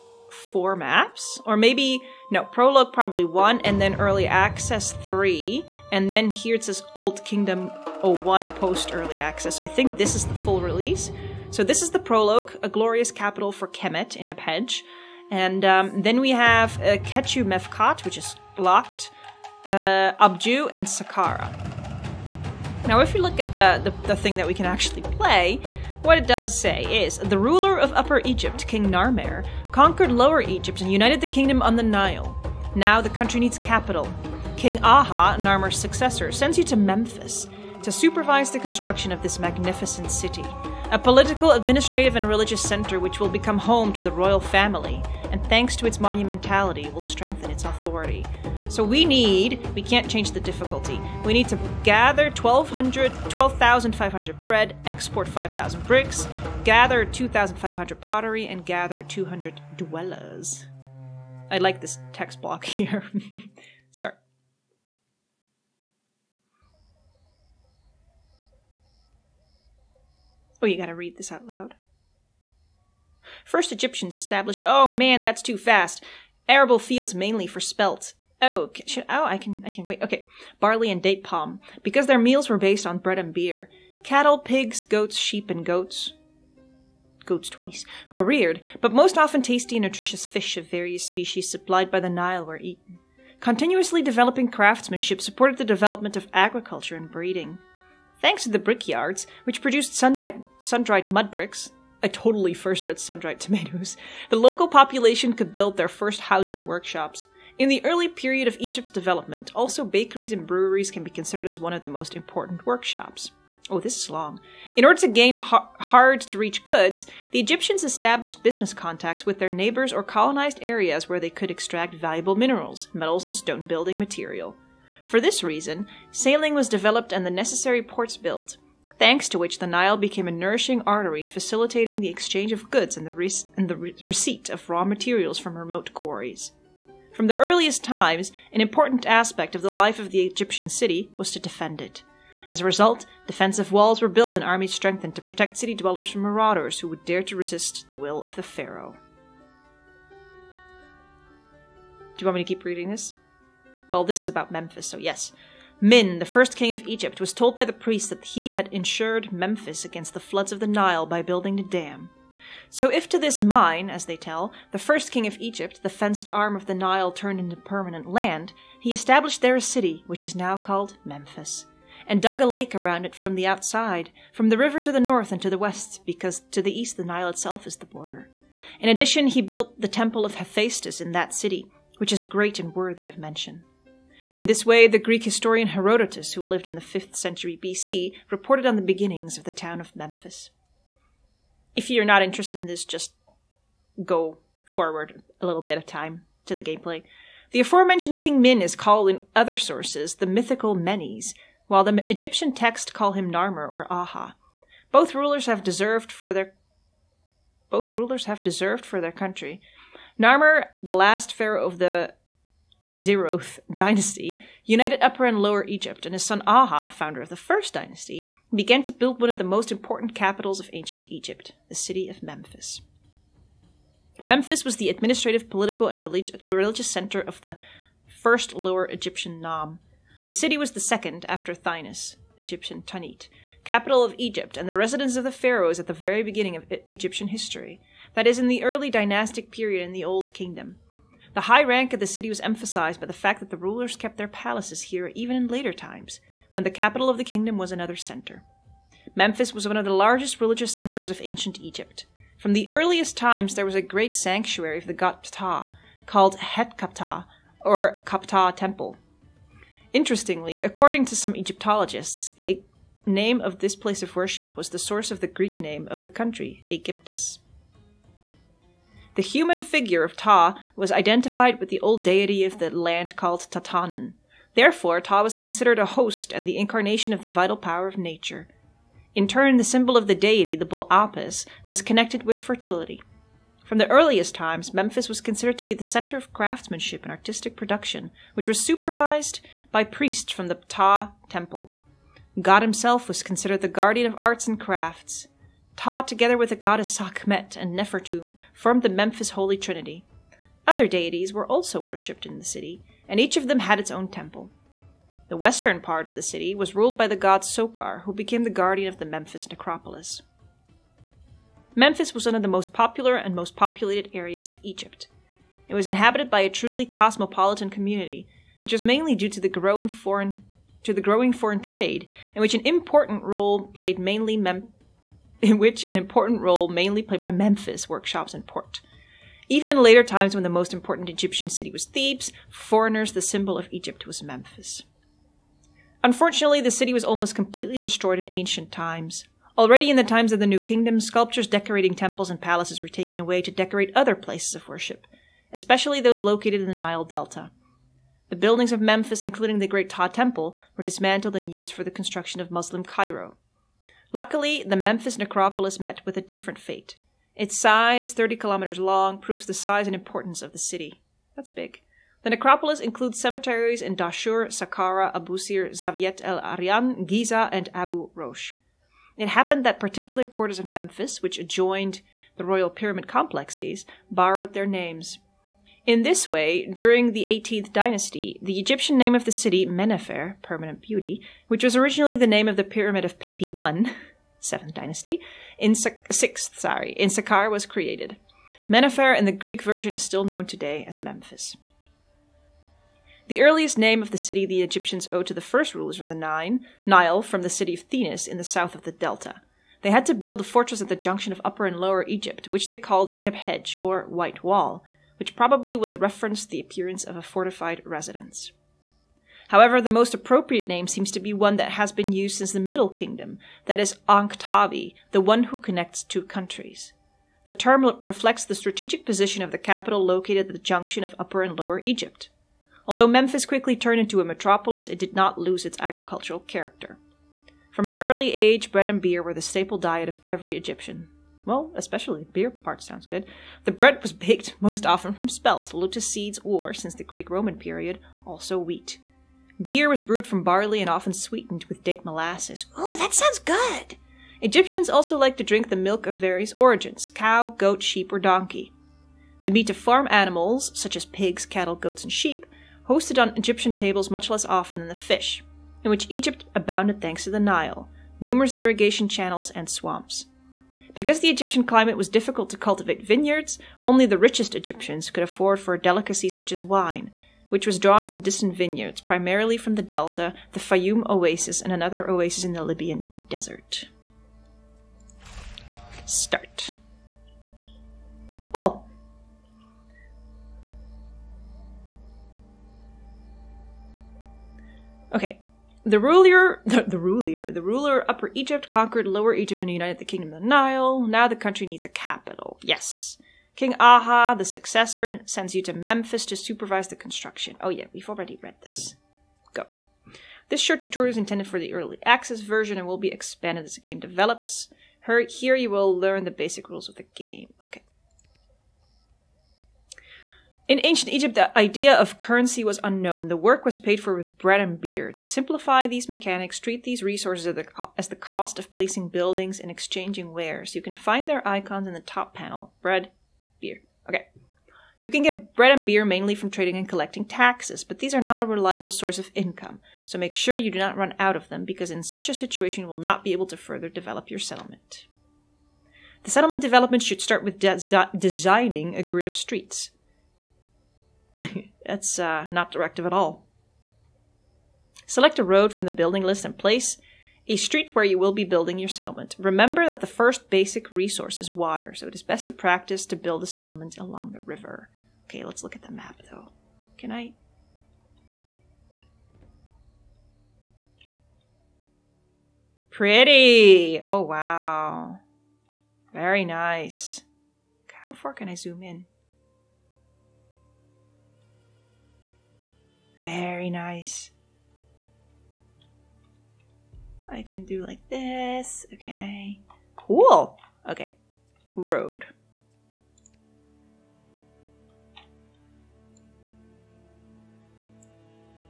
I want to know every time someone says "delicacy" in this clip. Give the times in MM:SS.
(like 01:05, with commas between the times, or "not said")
07:45.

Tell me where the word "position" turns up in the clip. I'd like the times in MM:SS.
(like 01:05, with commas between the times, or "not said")
06:59.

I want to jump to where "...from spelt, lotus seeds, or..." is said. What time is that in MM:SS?
07:15.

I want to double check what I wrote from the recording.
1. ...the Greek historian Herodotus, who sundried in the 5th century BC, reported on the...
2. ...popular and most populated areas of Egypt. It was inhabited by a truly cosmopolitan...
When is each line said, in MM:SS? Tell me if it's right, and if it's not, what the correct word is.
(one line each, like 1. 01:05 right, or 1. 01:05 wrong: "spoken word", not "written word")
1. 03:04 wrong: "lived", not "sundried"
2. 05:12 right.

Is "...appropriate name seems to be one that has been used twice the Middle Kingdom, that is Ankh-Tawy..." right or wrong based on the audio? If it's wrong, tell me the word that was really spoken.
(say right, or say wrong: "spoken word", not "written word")
wrong: "since", not "twice".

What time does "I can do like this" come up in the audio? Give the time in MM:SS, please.
09:37.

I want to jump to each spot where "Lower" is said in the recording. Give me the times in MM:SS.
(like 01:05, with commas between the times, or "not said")
00:30, 03:35, 03:48, 06:41, 07:01, 08:09.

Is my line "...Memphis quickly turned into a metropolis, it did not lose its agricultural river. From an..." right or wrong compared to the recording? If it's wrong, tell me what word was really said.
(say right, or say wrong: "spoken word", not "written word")
wrong: "character", not "river".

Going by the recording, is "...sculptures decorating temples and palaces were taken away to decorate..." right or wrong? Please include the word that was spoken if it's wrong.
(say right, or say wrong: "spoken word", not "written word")
right.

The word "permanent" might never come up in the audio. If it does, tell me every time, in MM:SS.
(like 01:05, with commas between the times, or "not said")
02:47, 06:20.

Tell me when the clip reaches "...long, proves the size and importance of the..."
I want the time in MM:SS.
05:58.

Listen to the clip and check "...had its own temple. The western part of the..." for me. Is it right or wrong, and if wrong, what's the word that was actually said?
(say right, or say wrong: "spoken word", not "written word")
right.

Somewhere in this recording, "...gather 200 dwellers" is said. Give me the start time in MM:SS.
00:58.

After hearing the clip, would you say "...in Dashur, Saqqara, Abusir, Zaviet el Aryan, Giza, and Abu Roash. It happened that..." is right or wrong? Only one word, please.
right.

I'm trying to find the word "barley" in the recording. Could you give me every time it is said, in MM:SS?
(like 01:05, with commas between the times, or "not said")
01:20, 07:20.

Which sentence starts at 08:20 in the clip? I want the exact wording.
This short tutorial is intended for the early access version and will be expanded as the game develops.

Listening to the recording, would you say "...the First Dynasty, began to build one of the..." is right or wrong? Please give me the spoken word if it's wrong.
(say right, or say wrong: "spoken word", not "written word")
right.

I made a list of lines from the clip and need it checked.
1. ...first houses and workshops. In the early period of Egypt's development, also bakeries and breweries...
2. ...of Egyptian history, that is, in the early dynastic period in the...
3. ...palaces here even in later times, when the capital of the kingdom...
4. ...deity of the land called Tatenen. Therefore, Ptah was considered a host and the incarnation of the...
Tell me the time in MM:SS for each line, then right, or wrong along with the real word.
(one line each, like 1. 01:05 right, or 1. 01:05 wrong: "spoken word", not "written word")
1. 01:45 right
2. 03:56 right
3. 04:04 right
4. 04:32 right.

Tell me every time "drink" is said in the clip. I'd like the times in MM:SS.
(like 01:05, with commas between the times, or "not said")
07:25.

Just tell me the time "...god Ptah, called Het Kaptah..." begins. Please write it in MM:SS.
04:14.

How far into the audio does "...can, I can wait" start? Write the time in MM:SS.
01:19.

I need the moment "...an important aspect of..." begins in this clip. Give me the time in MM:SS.
02:18.